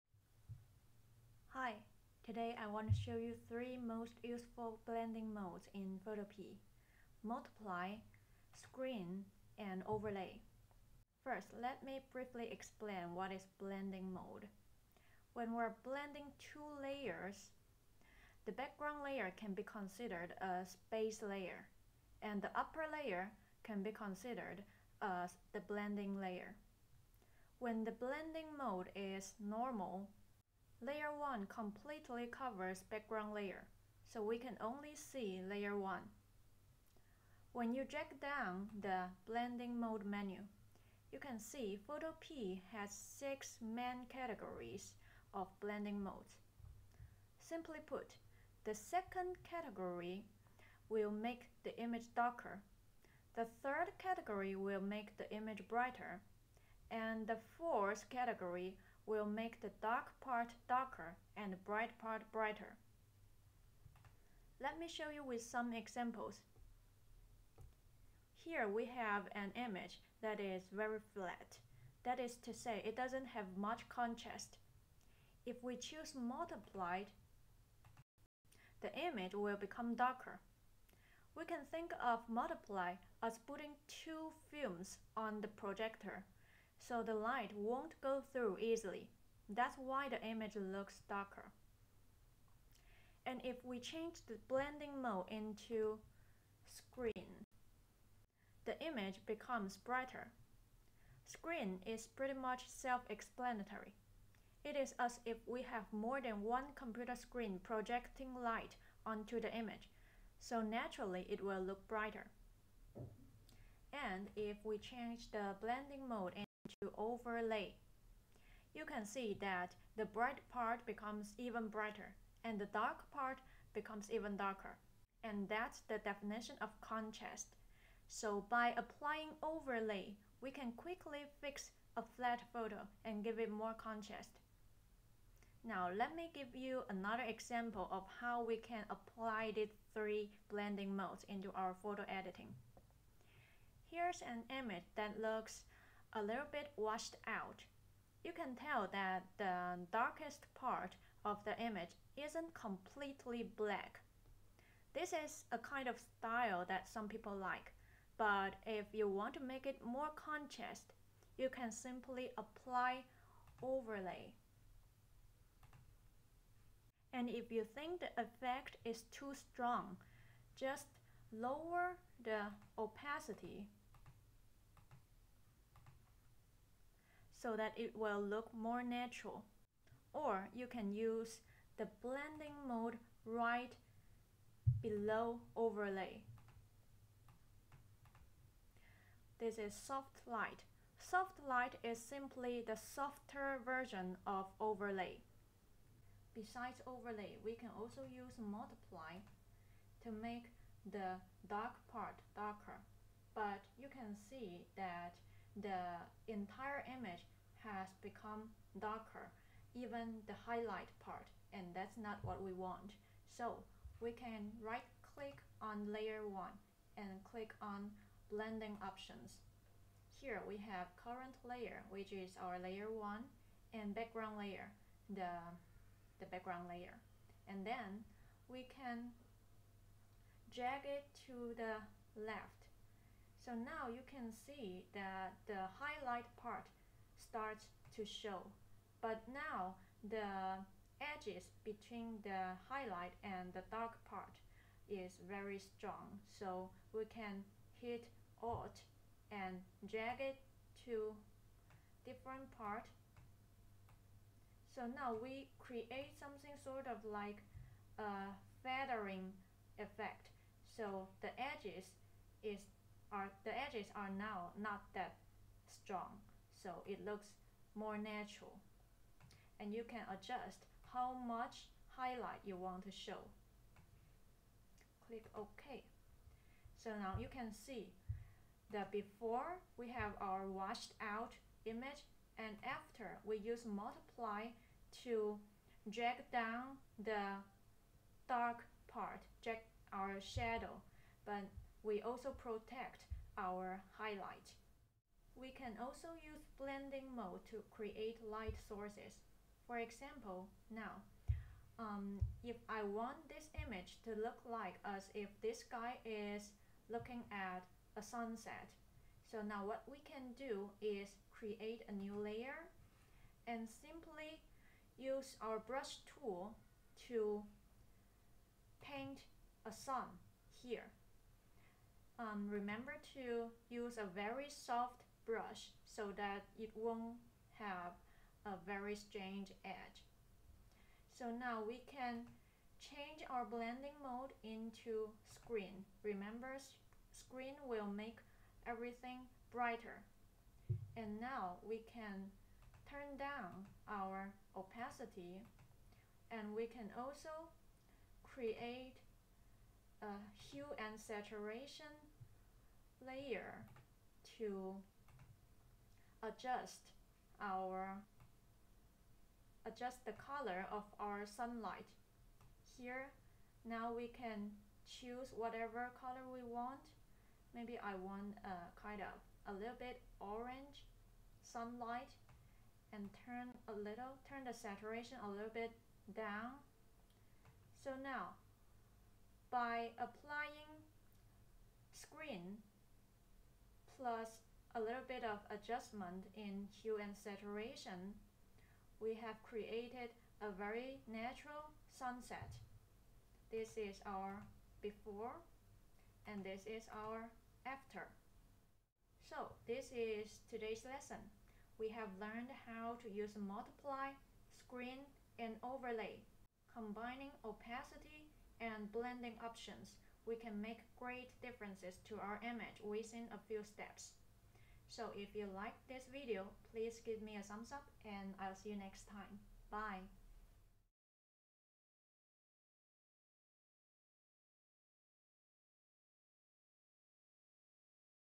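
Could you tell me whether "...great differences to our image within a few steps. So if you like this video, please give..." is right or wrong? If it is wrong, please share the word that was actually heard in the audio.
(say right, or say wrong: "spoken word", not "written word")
right.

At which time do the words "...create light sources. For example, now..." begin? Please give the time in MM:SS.
04:57.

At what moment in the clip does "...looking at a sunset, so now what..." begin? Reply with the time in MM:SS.
05:06.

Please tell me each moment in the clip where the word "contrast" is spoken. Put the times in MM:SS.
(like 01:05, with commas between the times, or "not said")
01:13, 02:06, 02:13, 02:40.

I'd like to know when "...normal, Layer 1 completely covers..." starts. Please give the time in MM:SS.
00:29.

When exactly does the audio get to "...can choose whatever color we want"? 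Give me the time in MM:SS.
06:04.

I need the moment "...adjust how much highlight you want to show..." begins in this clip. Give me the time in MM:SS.
04:30.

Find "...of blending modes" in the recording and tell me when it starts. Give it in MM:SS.
00:45.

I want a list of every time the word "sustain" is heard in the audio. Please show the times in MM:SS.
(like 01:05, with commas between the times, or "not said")
not said.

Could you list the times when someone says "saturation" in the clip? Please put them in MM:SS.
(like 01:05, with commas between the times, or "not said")
05:50, 06:14, 06:27.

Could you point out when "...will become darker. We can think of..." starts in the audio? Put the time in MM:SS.
01:19.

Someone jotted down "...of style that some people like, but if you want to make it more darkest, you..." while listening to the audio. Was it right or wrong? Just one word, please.
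wrong.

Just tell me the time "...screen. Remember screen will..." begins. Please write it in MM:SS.
05:35.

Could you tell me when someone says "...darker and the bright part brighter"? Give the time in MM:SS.
01:00.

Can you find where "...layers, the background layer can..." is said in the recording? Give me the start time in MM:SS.
00:16.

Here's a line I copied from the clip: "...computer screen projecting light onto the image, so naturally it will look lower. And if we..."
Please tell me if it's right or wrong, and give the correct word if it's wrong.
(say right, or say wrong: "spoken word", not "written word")
wrong: "brighter", not "lower".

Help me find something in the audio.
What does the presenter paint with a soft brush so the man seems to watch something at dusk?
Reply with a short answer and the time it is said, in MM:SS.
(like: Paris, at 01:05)
A sun, at 05:19.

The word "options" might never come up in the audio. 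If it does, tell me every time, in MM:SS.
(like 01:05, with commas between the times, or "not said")
03:38, 06:49.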